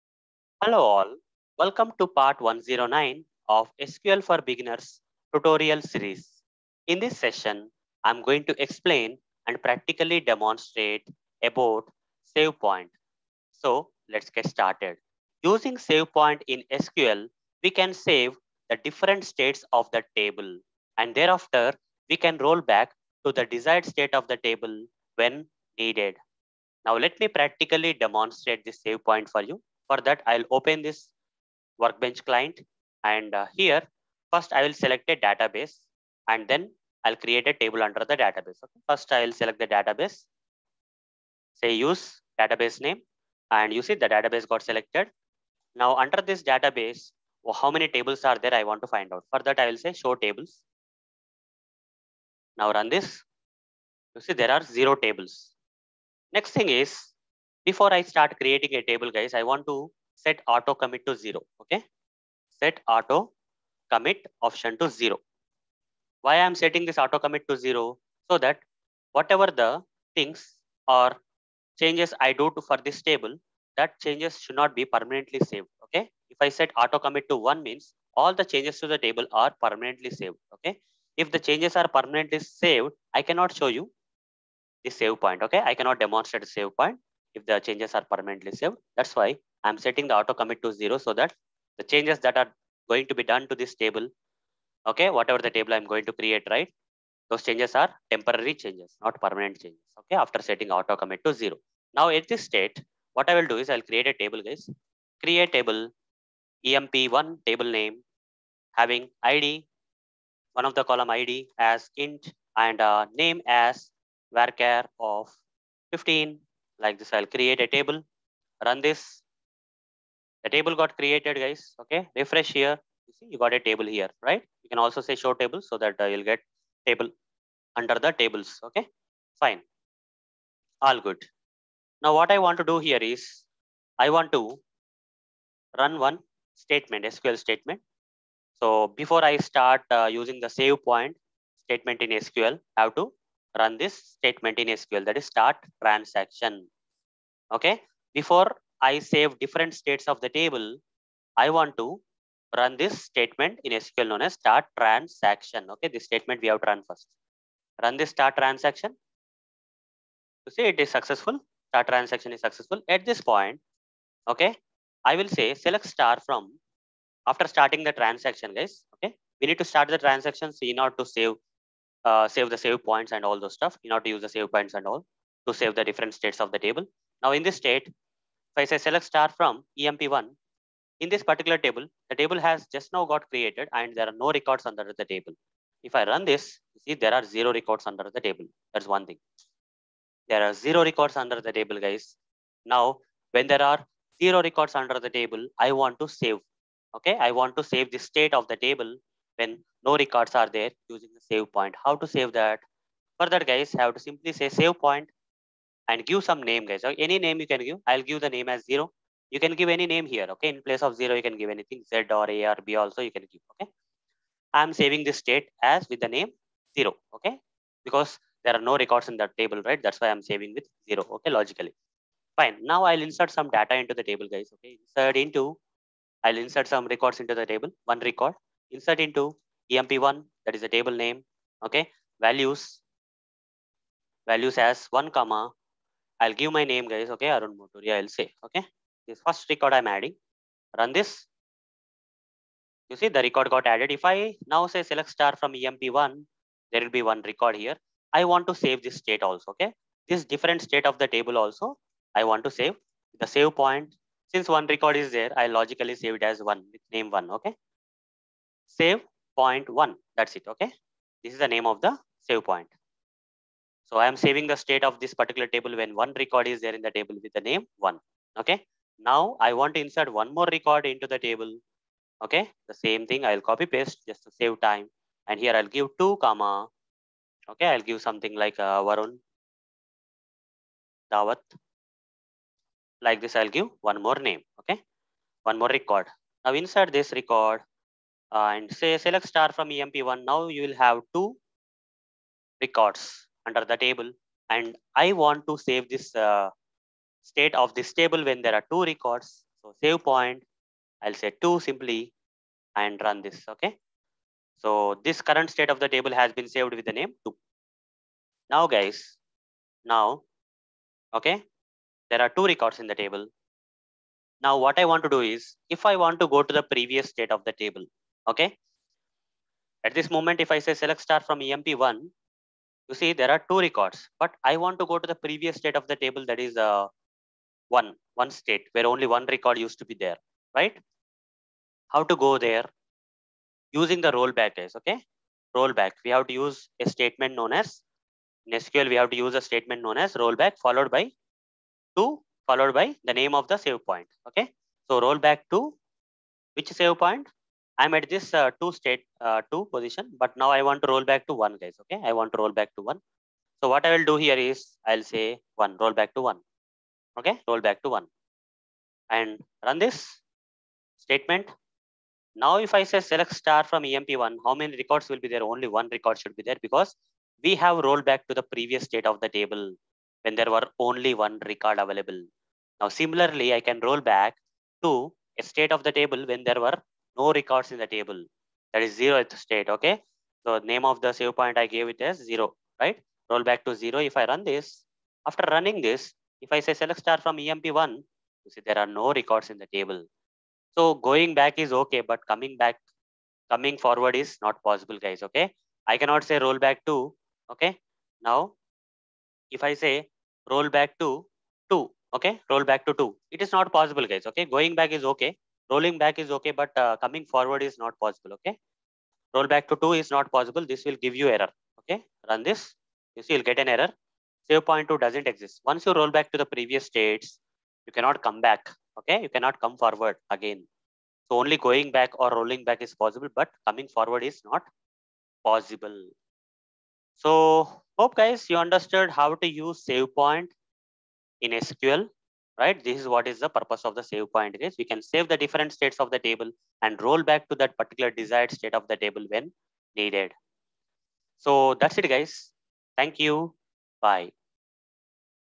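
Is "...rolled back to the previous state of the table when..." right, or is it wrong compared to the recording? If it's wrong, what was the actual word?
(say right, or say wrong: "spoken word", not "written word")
right.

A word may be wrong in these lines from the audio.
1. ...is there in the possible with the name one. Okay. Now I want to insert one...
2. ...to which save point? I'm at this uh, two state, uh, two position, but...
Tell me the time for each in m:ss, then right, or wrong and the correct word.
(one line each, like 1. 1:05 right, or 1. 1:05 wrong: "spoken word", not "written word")
1. 4:26 wrong: "table", not "possible"
2. 5:45 right.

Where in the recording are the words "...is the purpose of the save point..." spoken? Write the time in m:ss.
7:13.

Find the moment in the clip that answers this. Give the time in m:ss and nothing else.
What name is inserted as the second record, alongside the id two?
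4:38.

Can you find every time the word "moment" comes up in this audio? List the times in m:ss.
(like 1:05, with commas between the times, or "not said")
5:20.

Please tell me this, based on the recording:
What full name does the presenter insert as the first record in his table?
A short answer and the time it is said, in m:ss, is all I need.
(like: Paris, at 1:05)
Arun Motoori, at 3:57.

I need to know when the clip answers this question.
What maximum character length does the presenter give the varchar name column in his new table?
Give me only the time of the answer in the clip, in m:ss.
1:55.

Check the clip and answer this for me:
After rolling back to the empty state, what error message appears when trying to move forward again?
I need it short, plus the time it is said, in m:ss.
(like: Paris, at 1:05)
save point 2 doesn't exist, at 6:54.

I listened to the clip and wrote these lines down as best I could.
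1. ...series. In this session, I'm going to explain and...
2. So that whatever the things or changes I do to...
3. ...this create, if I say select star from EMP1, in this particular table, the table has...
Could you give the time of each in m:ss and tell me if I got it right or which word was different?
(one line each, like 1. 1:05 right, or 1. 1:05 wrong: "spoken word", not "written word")
1. 0:05 right
2. 1:08 right
3. 2:57 wrong: "state", not "create".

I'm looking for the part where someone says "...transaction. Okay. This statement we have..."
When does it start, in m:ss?
2:34.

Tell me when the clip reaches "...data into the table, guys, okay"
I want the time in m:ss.
3:43.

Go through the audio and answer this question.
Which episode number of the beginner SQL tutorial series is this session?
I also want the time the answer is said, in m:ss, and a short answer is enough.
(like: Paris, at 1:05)
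109, at 0:02.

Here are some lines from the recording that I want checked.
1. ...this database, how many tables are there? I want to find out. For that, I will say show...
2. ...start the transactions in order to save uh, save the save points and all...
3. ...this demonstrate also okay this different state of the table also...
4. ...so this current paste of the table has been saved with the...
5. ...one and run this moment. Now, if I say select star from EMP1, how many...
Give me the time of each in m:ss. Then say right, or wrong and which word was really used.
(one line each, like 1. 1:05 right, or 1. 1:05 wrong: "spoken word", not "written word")
1. 0:46 right
2. 2:49 right
3. 4:08 wrong: "state", not "demonstrate"
4. 5:04 wrong: "state", not "paste"
5. 5:57 wrong: "statement", not "moment".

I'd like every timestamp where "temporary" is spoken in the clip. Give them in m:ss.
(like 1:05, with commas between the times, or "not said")
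1:38.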